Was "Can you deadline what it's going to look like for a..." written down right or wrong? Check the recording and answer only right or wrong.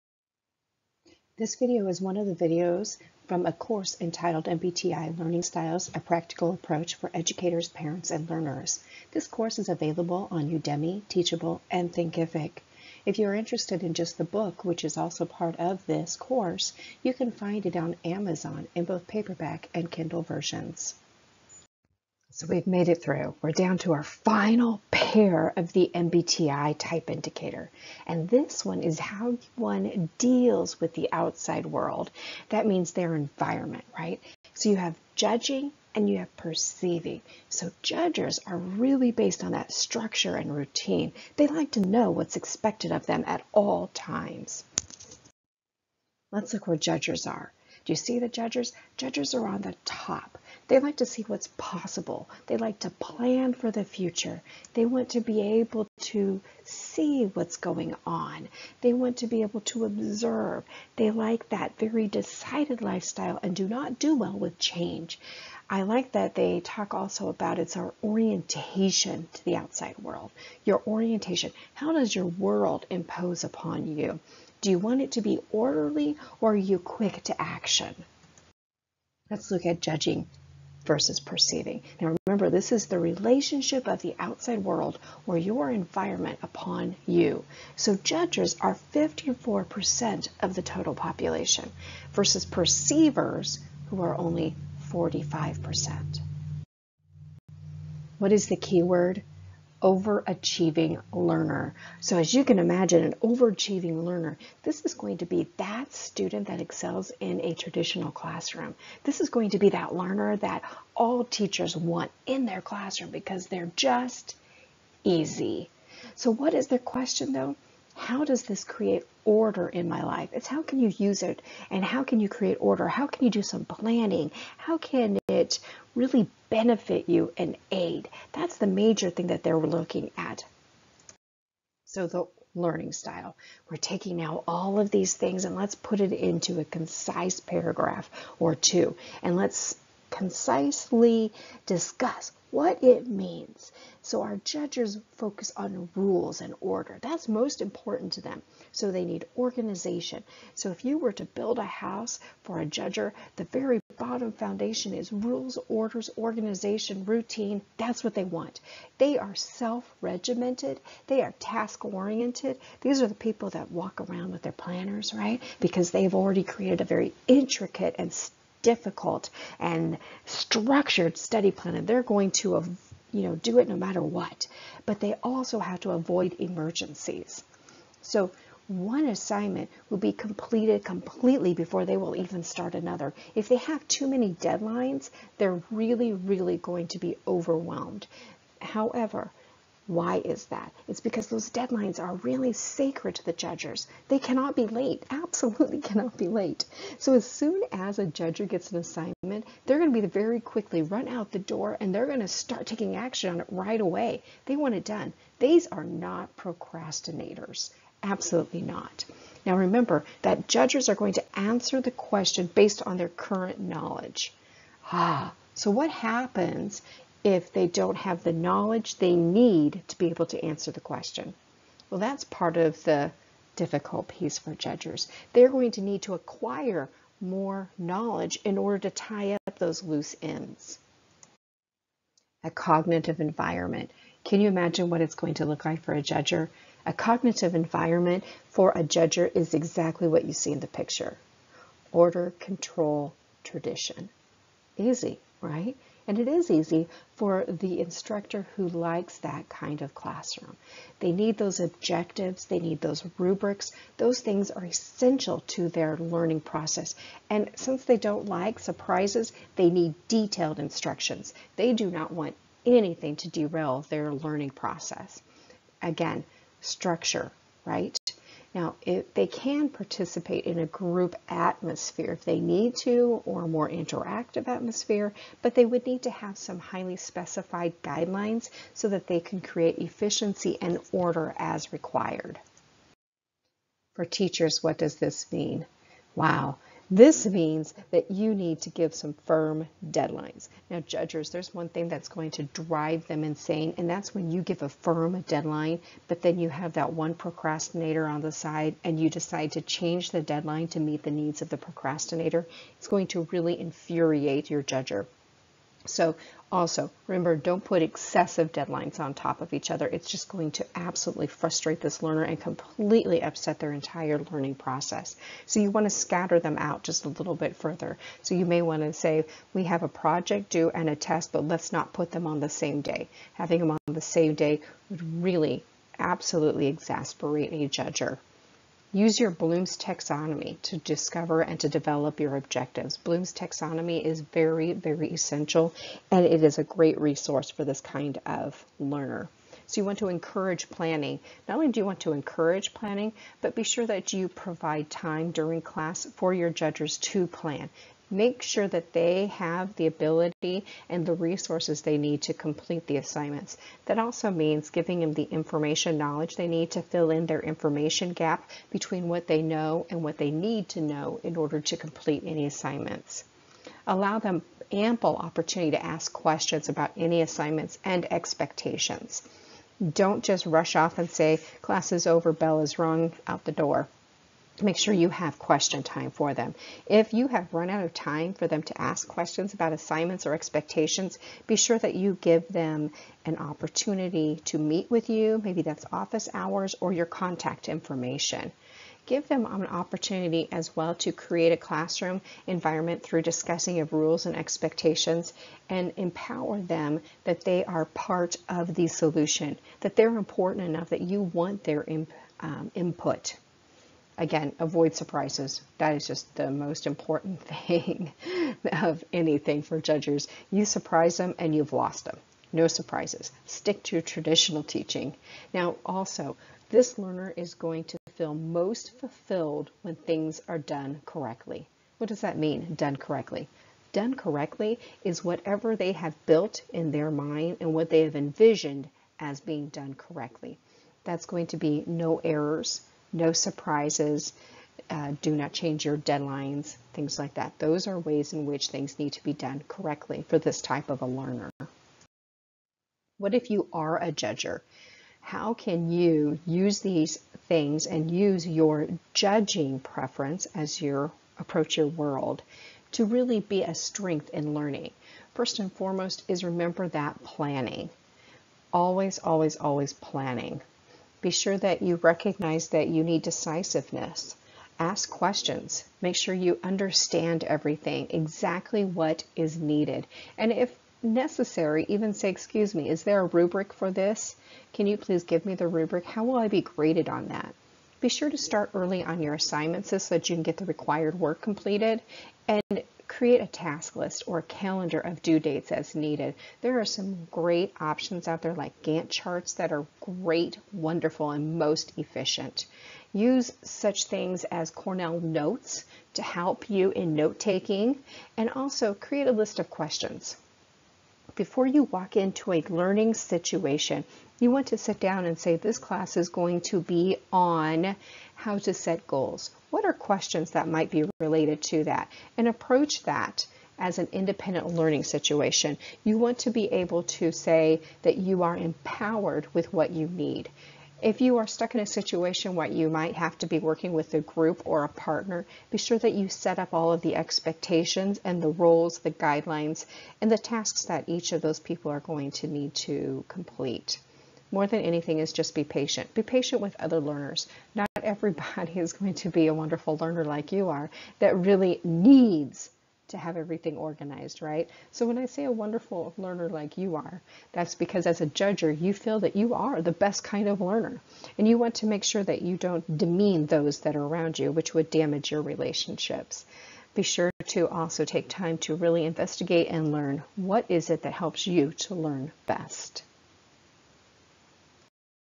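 wrong.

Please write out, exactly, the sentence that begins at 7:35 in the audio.
First and foremost is remember that planning.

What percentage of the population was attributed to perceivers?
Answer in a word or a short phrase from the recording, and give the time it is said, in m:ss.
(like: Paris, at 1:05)
45%, at 1:34.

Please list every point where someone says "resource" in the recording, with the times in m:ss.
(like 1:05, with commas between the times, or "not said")
5:36, 5:51.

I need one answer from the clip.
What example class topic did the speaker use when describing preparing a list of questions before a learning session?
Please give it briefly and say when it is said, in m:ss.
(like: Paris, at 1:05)
how to set goals, at 8:28.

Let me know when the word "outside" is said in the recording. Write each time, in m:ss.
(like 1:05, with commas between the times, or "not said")
0:31, 1:09, 1:24.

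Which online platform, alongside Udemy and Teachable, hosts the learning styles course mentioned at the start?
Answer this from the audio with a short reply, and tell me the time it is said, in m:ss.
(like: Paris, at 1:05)
Thinkific, at 0:11.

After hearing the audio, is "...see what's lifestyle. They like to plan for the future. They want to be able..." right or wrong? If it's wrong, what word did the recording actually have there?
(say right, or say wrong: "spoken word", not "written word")
wrong: "possible", not "lifestyle".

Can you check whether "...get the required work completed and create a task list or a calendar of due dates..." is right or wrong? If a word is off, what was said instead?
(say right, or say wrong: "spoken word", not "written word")
right.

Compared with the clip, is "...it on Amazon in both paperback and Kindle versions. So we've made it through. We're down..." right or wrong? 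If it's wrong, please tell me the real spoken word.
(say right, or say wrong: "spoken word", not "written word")
right.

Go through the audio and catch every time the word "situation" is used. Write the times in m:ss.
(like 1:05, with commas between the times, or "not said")
8:23, 8:35, 8:41.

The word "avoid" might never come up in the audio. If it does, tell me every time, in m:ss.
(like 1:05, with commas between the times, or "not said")
2:55, 6:44.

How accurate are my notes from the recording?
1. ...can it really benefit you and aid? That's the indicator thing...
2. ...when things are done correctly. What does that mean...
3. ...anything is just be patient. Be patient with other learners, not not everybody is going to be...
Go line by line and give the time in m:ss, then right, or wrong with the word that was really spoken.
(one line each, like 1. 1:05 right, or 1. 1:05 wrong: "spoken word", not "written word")
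1. 2:04 wrong: "major", not "indicator"
2. 6:59 right
3. 8:54 right.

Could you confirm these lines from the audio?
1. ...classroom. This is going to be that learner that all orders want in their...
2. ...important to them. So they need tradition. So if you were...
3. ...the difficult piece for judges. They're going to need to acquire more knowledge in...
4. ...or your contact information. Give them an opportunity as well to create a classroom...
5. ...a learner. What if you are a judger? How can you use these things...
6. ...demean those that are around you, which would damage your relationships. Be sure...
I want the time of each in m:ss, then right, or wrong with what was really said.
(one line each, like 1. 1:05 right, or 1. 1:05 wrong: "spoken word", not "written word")
1. 1:48 wrong: "teachers", not "orders"
2. 2:27 wrong: "organization", not "tradition"
3. 3:42 right
4. 6:26 right
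5. 7:21 right
6. 9:12 right.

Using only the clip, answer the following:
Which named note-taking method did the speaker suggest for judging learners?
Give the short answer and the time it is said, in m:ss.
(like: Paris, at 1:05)
Cornell Notes, at 8:14.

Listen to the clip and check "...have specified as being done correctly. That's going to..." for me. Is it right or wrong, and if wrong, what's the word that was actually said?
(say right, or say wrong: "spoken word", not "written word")
wrong: "envisioned", not "specified".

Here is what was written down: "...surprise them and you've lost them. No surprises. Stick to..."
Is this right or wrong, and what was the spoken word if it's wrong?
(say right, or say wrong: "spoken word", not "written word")
right.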